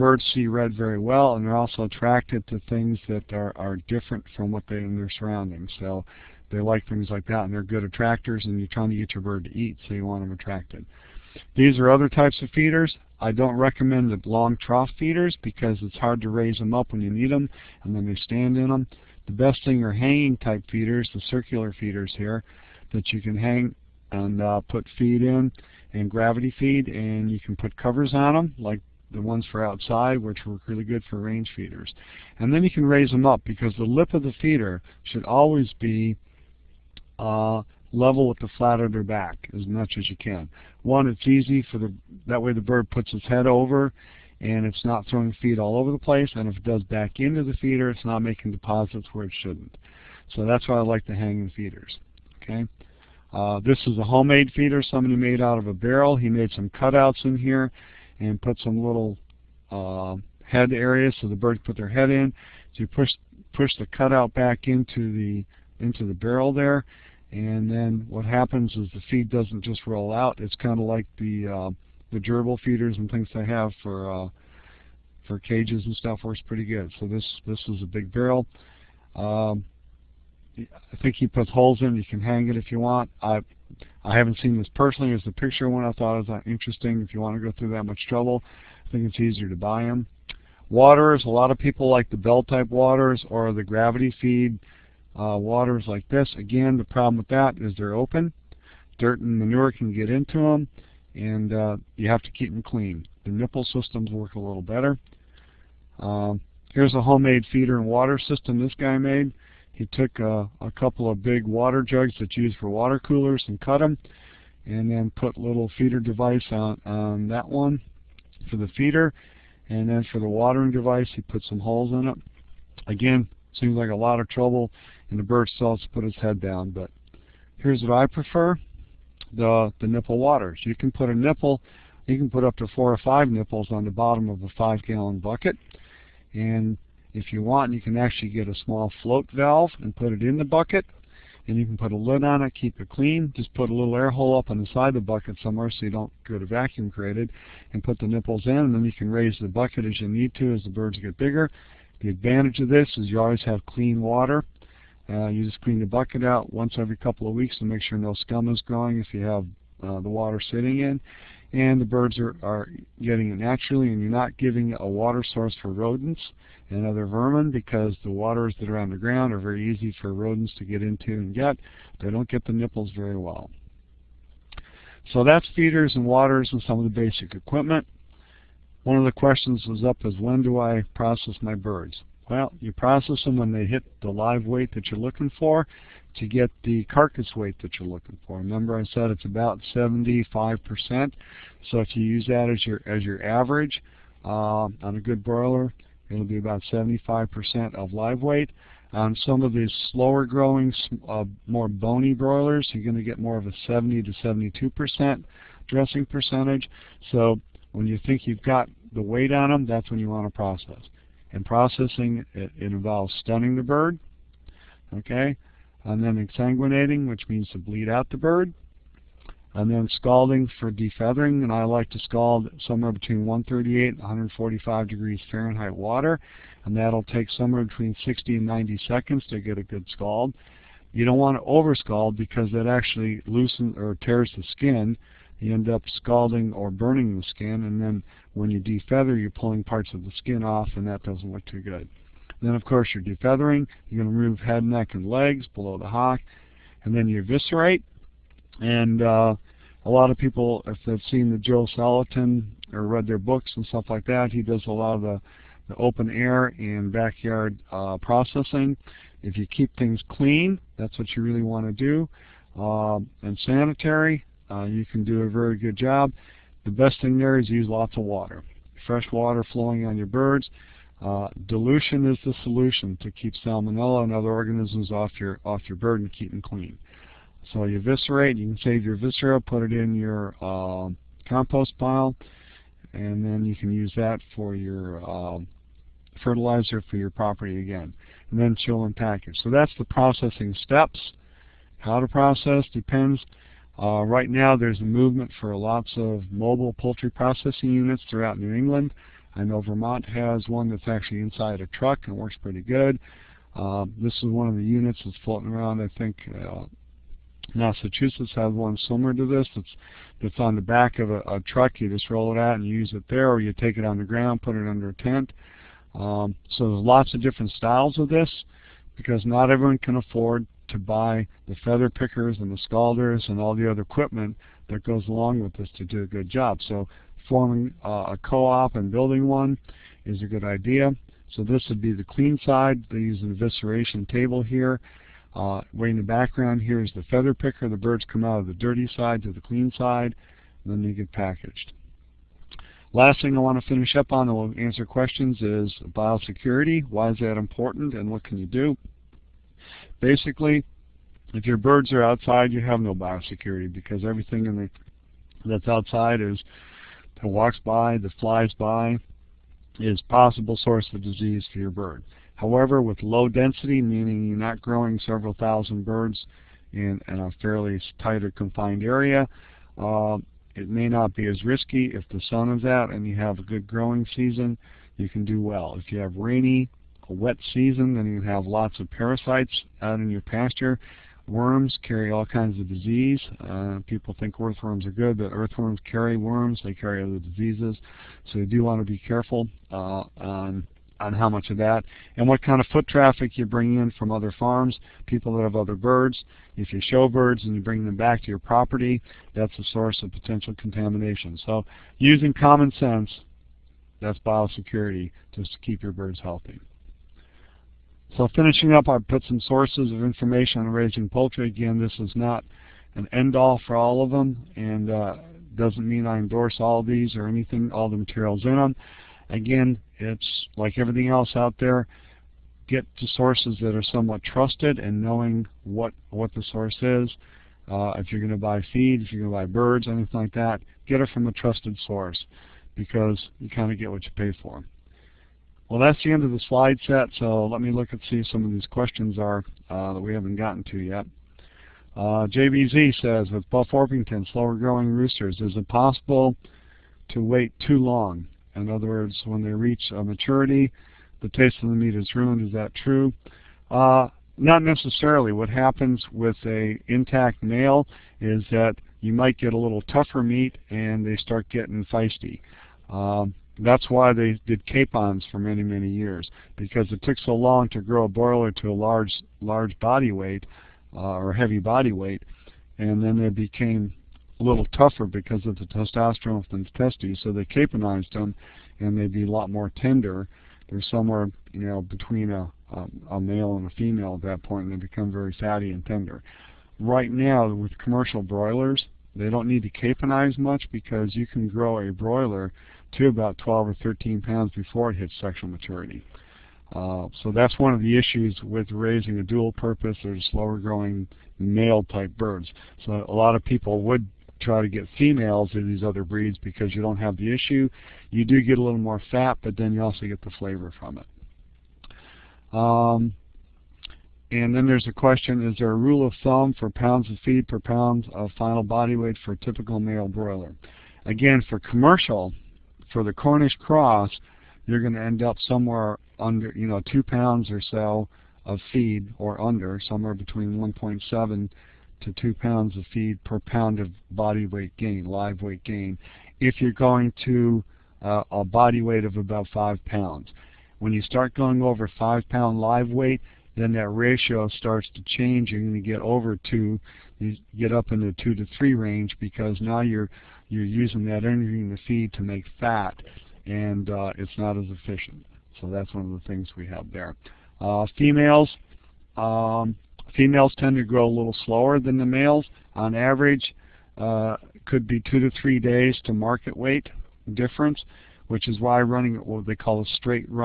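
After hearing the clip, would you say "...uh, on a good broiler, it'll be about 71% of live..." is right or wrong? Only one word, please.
wrong.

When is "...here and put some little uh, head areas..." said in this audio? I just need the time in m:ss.
0:57.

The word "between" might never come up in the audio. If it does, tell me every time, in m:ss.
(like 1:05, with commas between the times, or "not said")
3:42, 3:47, 8:01, 8:50.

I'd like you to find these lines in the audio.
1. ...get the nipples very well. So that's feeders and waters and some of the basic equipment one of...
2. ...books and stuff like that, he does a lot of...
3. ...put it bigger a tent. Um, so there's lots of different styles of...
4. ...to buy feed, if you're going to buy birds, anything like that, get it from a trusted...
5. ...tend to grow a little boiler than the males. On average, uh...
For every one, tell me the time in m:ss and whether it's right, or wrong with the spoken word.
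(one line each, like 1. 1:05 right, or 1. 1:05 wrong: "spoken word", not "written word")
1. 2:52 right
2. 4:13 right
3. 5:14 wrong: "under", not "bigger"
4. 7:08 right
5. 9:20 wrong: "slower", not "boiler".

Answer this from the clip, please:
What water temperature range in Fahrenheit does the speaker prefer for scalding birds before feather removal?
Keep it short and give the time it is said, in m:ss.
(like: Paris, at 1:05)
138 to 145 degrees, at 3:43.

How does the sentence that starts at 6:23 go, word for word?
Uh, people think earthworms are good, but earthworms carry worms.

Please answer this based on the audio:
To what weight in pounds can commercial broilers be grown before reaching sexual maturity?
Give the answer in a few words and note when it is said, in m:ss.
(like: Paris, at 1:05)
12 or 13 pounds, at 8:13.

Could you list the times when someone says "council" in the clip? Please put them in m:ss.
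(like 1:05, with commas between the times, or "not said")
not said.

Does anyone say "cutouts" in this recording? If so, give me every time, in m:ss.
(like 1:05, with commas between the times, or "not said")
0:56, 1:03.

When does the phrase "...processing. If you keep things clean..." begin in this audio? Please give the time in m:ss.
4:17.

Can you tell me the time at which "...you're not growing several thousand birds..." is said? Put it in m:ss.
6:04.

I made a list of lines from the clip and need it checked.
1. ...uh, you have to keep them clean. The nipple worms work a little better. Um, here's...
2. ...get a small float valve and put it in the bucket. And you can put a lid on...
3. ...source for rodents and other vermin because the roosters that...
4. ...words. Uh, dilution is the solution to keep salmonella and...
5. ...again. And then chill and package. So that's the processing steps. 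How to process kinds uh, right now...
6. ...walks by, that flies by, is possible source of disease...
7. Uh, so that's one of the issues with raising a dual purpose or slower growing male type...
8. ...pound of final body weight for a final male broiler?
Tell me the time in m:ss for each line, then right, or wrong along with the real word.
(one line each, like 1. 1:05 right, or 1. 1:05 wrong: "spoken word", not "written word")
1. 1:41 wrong: "systems", not "worms"
2. 2:18 right
3. 2:45 wrong: "waters", not "roosters"
4. 4:30 wrong: "birds", not "words"
5. 4:47 wrong: "depends", not "kinds"
6. 5:57 right
7. 8:16 right
8. 8:37 wrong: "typical", not "final".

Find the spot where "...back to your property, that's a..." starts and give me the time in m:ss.
6:37.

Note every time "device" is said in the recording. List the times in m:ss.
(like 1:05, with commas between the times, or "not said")
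1:56, 2:00.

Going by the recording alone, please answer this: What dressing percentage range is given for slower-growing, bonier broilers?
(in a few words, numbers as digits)
70 to 72%.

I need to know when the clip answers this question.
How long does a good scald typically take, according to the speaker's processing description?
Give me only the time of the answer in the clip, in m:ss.
3:48.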